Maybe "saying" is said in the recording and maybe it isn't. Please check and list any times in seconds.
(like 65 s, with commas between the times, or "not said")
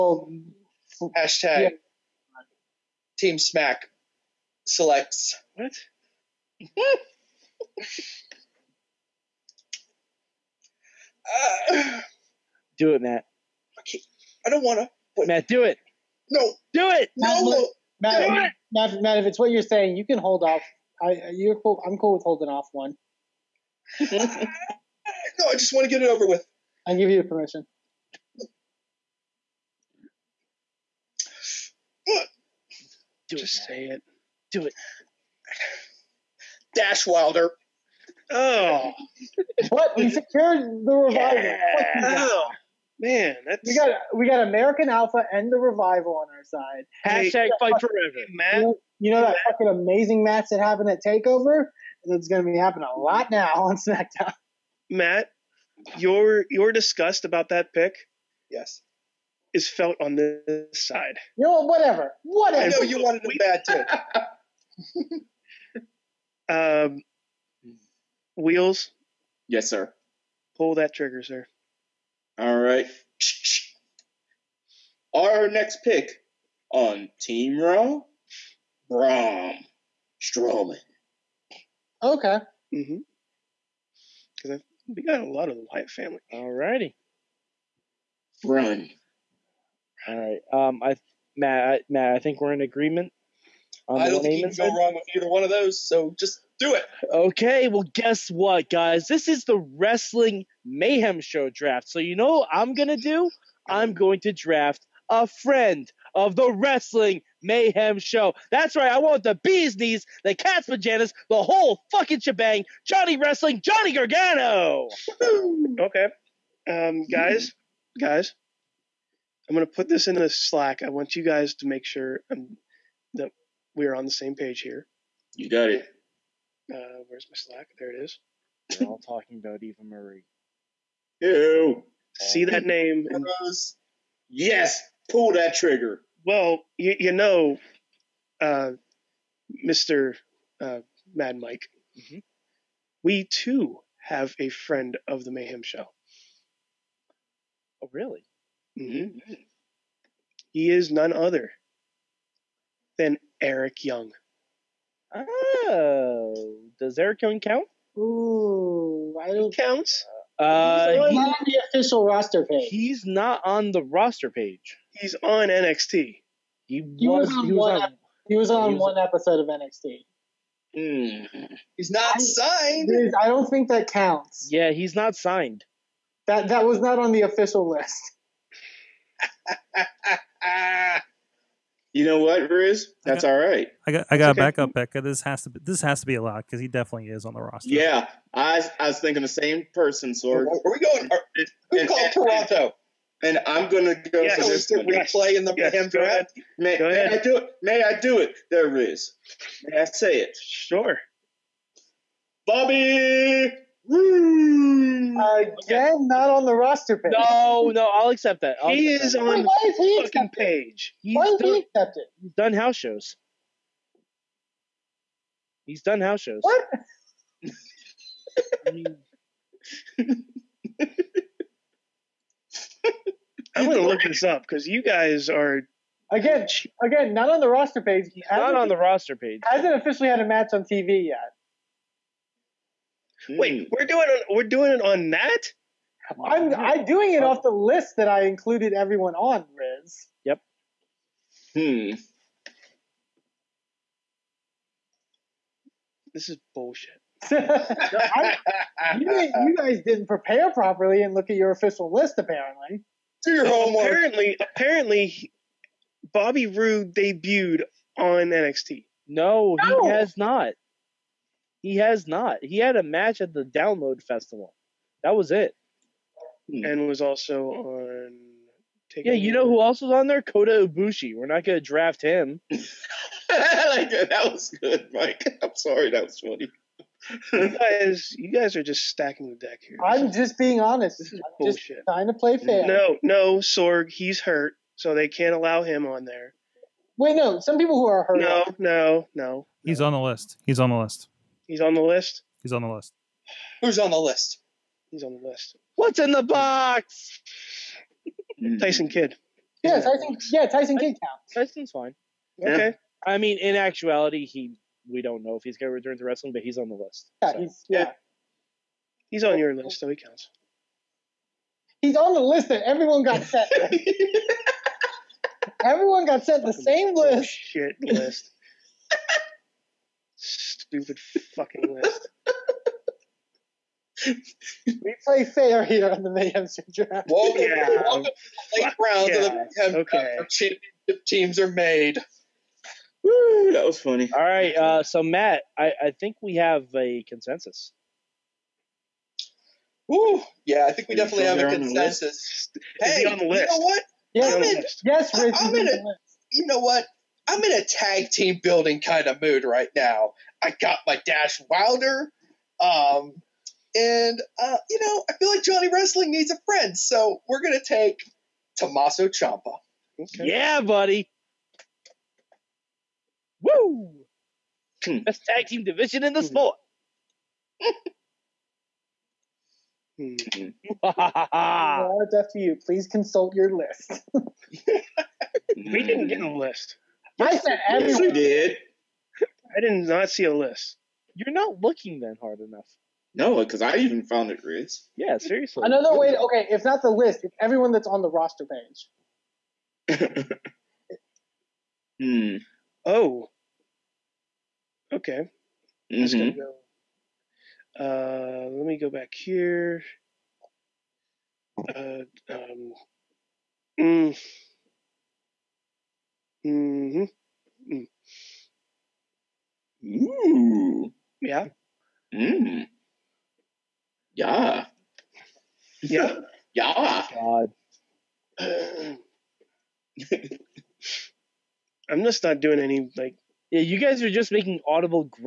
19 s.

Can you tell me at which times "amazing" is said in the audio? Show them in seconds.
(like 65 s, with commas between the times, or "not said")
49 s.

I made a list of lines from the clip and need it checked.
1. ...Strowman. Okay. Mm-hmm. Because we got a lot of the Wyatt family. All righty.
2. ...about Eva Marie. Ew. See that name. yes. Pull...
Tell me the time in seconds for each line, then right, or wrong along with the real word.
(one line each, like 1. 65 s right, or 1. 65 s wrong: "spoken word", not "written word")
1. 80 s right
2. 129 s right.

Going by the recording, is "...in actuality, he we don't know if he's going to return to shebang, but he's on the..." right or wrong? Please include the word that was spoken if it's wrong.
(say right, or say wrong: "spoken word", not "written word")
wrong: "wrestling", not "shebang".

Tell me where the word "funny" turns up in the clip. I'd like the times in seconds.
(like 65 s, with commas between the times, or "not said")
276 s, 333 s.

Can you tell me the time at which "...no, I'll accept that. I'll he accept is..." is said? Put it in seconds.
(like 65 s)
207 s.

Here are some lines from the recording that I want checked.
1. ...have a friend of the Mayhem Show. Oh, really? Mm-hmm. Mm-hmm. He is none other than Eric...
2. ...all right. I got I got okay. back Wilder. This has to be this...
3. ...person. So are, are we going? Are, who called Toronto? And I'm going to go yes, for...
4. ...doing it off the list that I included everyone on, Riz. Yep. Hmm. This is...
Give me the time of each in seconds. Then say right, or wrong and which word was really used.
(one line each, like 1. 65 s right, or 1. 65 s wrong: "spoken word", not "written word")
1. 143 s right
2. 183 s wrong: "Becca", not "Wilder"
3. 189 s right
4. 236 s right.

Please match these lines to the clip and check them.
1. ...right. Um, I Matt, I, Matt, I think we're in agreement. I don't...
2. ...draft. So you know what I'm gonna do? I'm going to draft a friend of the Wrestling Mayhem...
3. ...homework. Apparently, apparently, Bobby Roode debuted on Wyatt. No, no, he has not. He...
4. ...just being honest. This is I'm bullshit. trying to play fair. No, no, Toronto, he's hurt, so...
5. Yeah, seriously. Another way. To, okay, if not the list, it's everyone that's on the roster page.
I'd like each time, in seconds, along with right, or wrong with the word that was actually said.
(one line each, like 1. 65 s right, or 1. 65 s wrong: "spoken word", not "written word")
1. 90 s right
2. 101 s right
3. 253 s wrong: "NXT", not "Wyatt"
4. 280 s wrong: "Sorg", not "Toronto"
5. 384 s right.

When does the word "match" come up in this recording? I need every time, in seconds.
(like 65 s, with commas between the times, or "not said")
50 s, 230 s, 262 s.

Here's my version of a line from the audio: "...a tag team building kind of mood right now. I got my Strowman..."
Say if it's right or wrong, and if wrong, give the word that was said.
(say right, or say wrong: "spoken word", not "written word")
wrong: "Dash", not "Strowman".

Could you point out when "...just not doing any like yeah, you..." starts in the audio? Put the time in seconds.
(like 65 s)
422 s.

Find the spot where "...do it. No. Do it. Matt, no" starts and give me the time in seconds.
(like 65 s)
15 s.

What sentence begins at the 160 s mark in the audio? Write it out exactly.
Uh, he's, not on the official roster page.